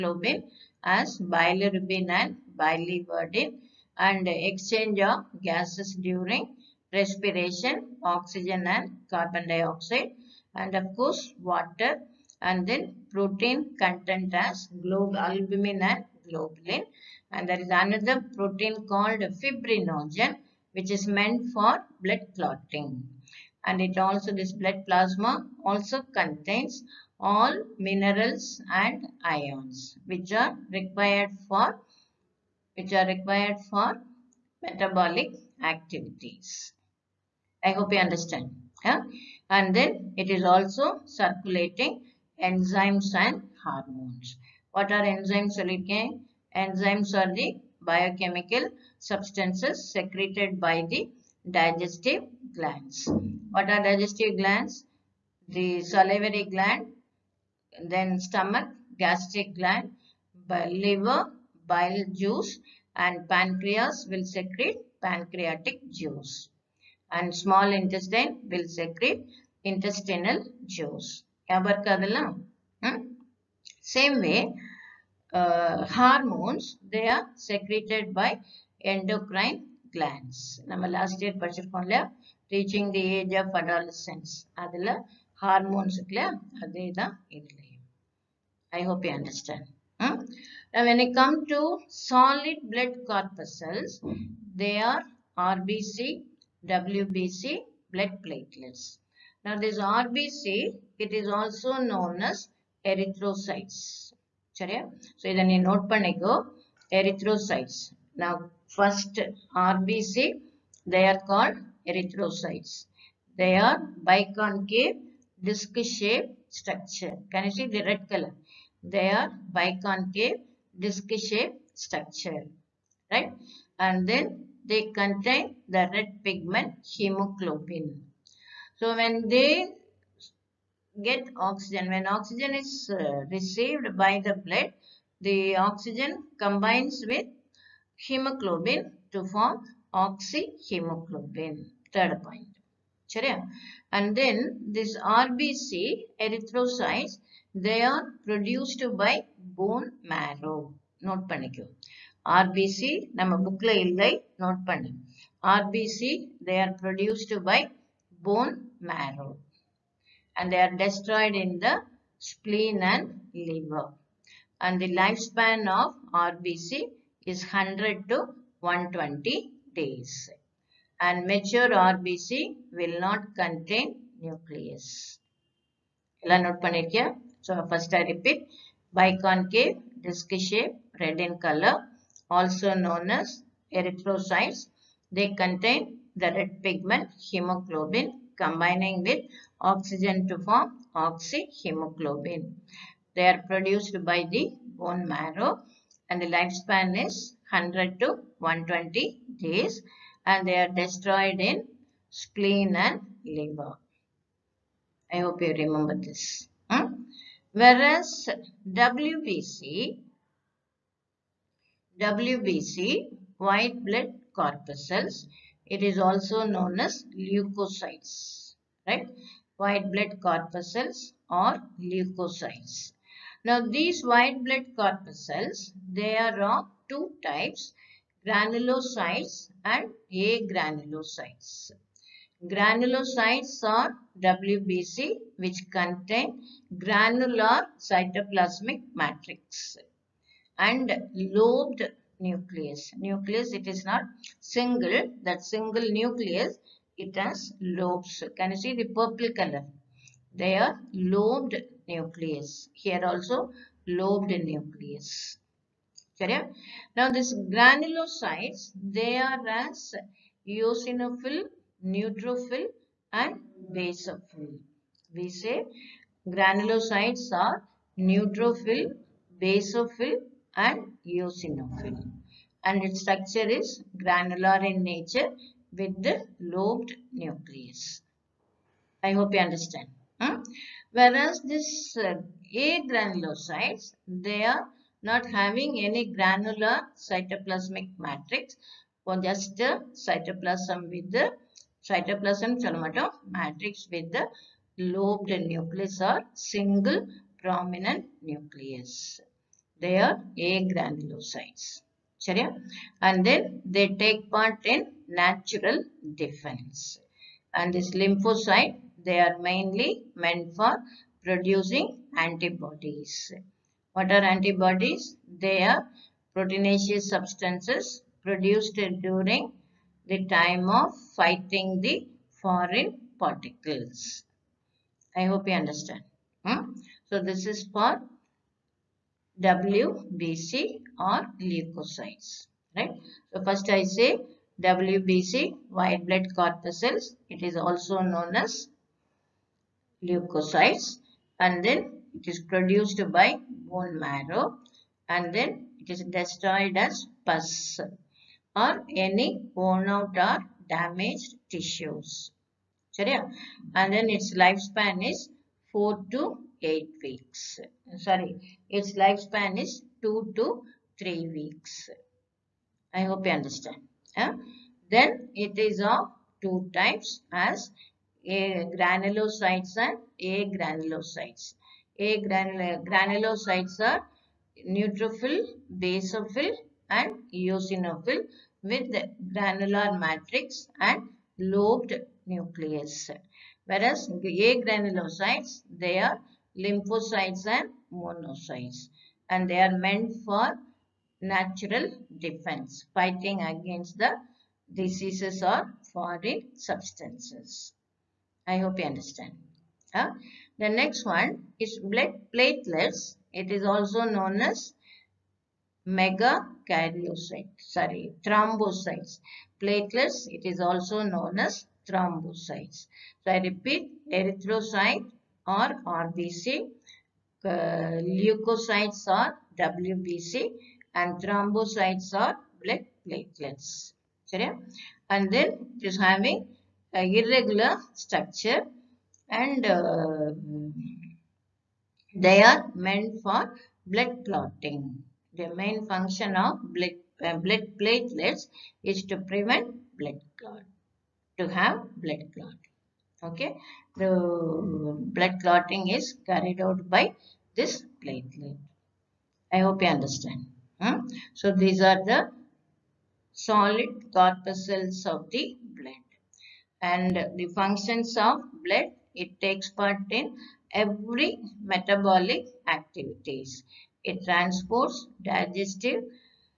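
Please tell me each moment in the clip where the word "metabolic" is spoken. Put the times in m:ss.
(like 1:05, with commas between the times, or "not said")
0:34, 7:41.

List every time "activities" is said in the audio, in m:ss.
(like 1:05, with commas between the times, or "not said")
0:35, 7:42.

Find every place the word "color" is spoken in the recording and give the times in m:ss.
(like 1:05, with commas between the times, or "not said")
1:58, 3:01, 4:09.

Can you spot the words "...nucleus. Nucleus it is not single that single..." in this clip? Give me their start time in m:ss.
4:02.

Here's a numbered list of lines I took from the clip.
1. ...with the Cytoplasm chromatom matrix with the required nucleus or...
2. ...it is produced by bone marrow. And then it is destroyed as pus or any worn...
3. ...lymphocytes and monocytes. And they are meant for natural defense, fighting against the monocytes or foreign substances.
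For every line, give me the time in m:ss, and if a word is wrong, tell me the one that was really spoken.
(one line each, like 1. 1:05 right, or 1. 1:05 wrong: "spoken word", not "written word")
1. 4:50 wrong: "lobed", not "required"
2. 5:42 right
3. 6:26 wrong: "diseases", not "monocytes".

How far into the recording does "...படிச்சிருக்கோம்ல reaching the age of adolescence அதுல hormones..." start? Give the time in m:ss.
1:21.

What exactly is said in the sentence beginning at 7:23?
Okay, the blood clotting is carried out by this platelet.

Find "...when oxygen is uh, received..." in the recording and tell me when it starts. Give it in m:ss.
2:11.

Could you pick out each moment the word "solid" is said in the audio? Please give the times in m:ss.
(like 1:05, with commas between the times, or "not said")
1:31, 7:33.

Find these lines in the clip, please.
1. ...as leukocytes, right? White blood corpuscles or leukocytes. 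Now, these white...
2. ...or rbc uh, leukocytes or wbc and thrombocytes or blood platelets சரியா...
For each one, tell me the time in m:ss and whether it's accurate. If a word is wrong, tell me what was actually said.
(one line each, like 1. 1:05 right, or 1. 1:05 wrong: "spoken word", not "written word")
1. 3:36 right
2. 6:55 right.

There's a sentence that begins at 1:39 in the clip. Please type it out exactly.
Now this RBC, it is also known as erythrocytes.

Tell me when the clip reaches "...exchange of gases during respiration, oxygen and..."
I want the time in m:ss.
0:04.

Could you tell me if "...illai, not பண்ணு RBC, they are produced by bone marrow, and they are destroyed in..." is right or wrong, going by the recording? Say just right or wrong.
right.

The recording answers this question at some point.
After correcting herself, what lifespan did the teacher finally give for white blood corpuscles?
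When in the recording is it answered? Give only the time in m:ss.
6:00.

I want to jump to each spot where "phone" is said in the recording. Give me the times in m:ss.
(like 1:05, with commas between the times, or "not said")
not said.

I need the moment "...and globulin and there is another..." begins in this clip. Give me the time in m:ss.
0:15.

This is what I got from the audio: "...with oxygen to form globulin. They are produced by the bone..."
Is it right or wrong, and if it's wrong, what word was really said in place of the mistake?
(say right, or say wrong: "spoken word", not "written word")
wrong: "oxyhemoglobin", not "globulin".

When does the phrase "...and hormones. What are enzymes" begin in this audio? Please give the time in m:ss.
0:43.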